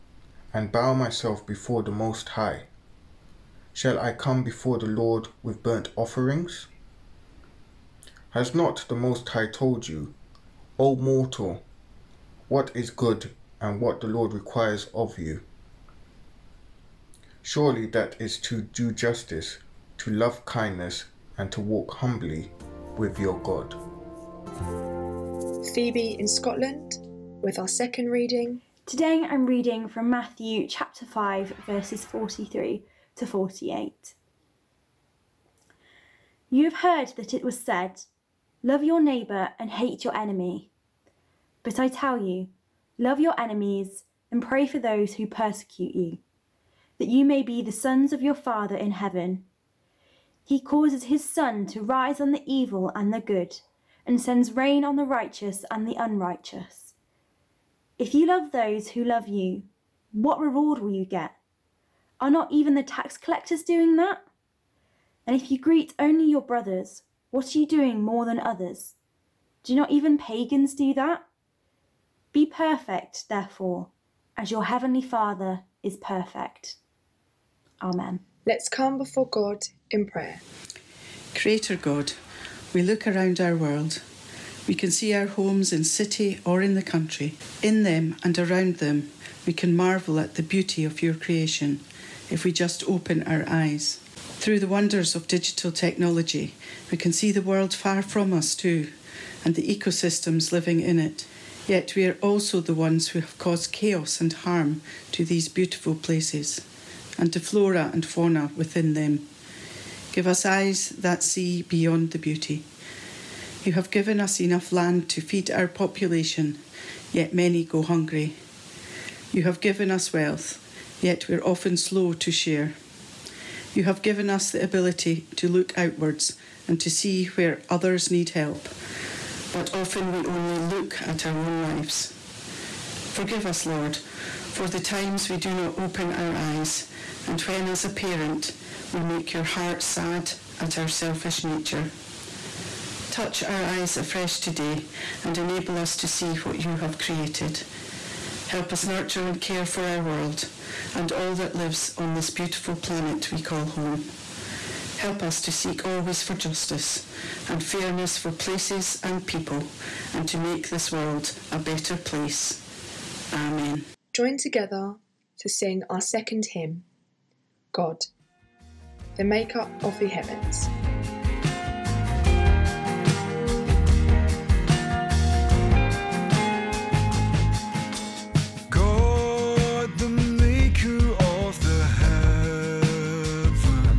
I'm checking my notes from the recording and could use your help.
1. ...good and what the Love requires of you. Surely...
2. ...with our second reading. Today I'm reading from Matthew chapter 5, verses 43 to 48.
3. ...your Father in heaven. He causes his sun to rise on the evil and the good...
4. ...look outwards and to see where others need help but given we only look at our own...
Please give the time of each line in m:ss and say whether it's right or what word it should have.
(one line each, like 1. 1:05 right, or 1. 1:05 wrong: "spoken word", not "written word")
1. 0:12 wrong: "Lord", not "Love"
2. 0:27 right
3. 0:48 right
4. 2:05 wrong: "often", not "given".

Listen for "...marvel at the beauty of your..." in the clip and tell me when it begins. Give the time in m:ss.
1:29.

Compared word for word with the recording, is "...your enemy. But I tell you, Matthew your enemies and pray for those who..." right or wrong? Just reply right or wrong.
wrong.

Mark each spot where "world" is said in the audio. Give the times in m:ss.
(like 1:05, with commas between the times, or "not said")
1:23, 1:37, 2:30, 2:40.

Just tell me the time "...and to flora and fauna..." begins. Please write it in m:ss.
1:47.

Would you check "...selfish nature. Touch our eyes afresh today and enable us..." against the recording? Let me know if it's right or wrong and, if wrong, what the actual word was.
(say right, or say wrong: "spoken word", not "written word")
right.